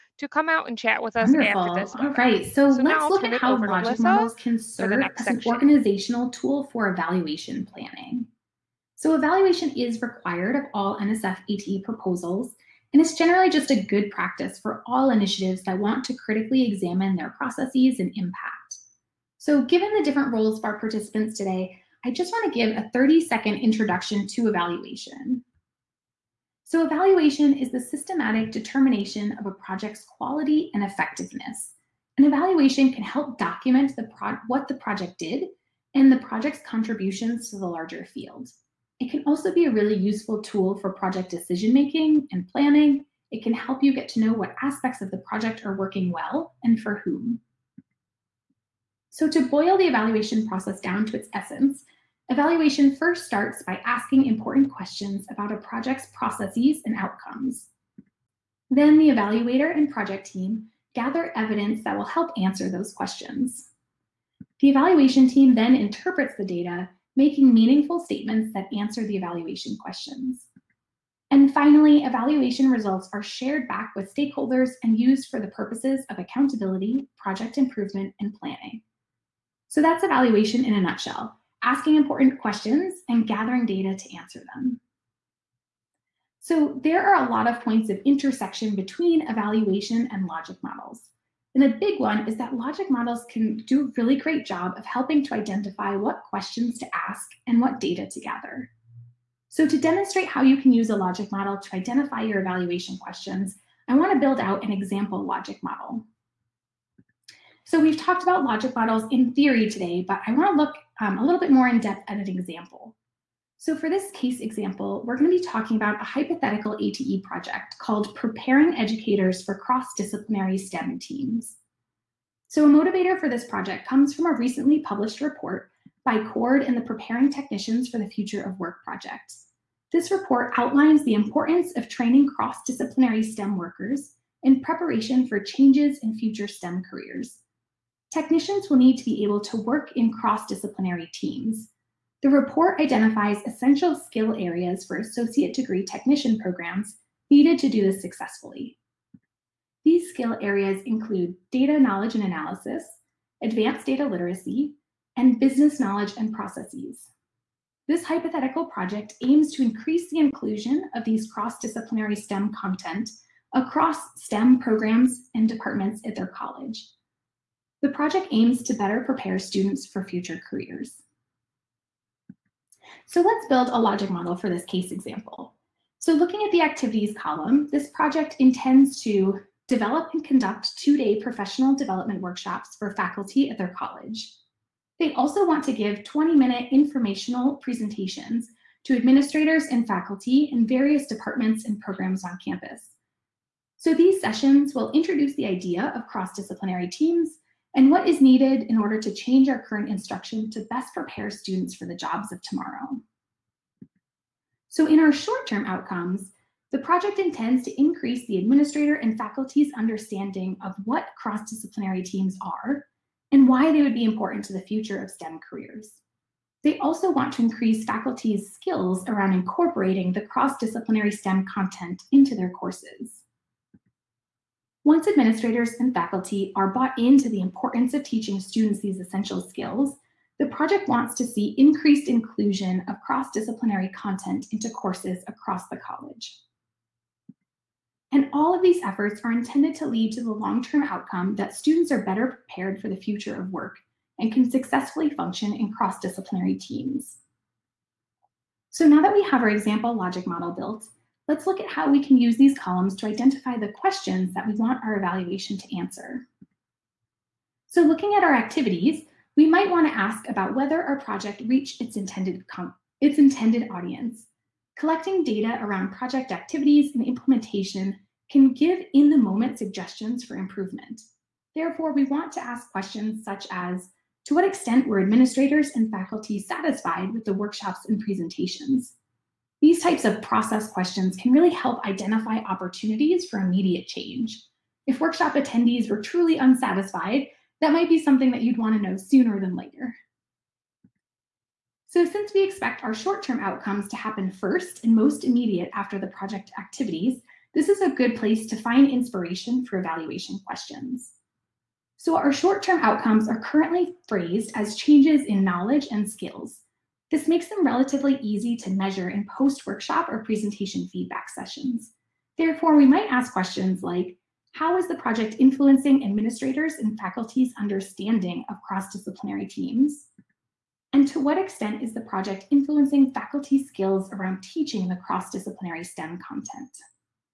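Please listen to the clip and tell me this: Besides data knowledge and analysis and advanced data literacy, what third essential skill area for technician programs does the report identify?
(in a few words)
business knowledge and processes.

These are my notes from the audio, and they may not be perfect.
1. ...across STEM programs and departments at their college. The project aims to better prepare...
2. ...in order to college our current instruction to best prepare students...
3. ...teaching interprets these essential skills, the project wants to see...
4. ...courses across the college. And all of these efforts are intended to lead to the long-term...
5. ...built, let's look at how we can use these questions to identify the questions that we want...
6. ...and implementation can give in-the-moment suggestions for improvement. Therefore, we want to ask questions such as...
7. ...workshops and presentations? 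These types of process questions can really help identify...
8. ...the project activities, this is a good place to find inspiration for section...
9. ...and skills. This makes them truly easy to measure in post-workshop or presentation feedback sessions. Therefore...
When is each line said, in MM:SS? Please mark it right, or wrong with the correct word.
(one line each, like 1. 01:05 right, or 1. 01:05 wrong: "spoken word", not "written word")
1. 02:43 right
2. 03:18 wrong: "change", not "college"
3. 03:48 wrong: "students", not "interprets"
4. 03:54 right
5. 04:10 wrong: "columns", not "questions"
6. 04:26 right
7. 04:37 right
8. 04:55 wrong: "evaluation", not "section"
9. 05:05 wrong: "relatively", not "truly".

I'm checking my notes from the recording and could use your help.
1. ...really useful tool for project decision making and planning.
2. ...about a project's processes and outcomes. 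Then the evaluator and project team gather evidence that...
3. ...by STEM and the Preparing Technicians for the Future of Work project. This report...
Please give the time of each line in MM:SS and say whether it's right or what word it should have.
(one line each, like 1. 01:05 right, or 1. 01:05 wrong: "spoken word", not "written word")
1. 00:39 right
2. 00:55 right
3. 02:06 wrong: "CORD", not "STEM".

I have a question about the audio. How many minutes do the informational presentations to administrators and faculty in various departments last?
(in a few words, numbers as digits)
20 minutes.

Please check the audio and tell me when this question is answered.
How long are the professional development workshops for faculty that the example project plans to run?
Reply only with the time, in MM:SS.
03:00.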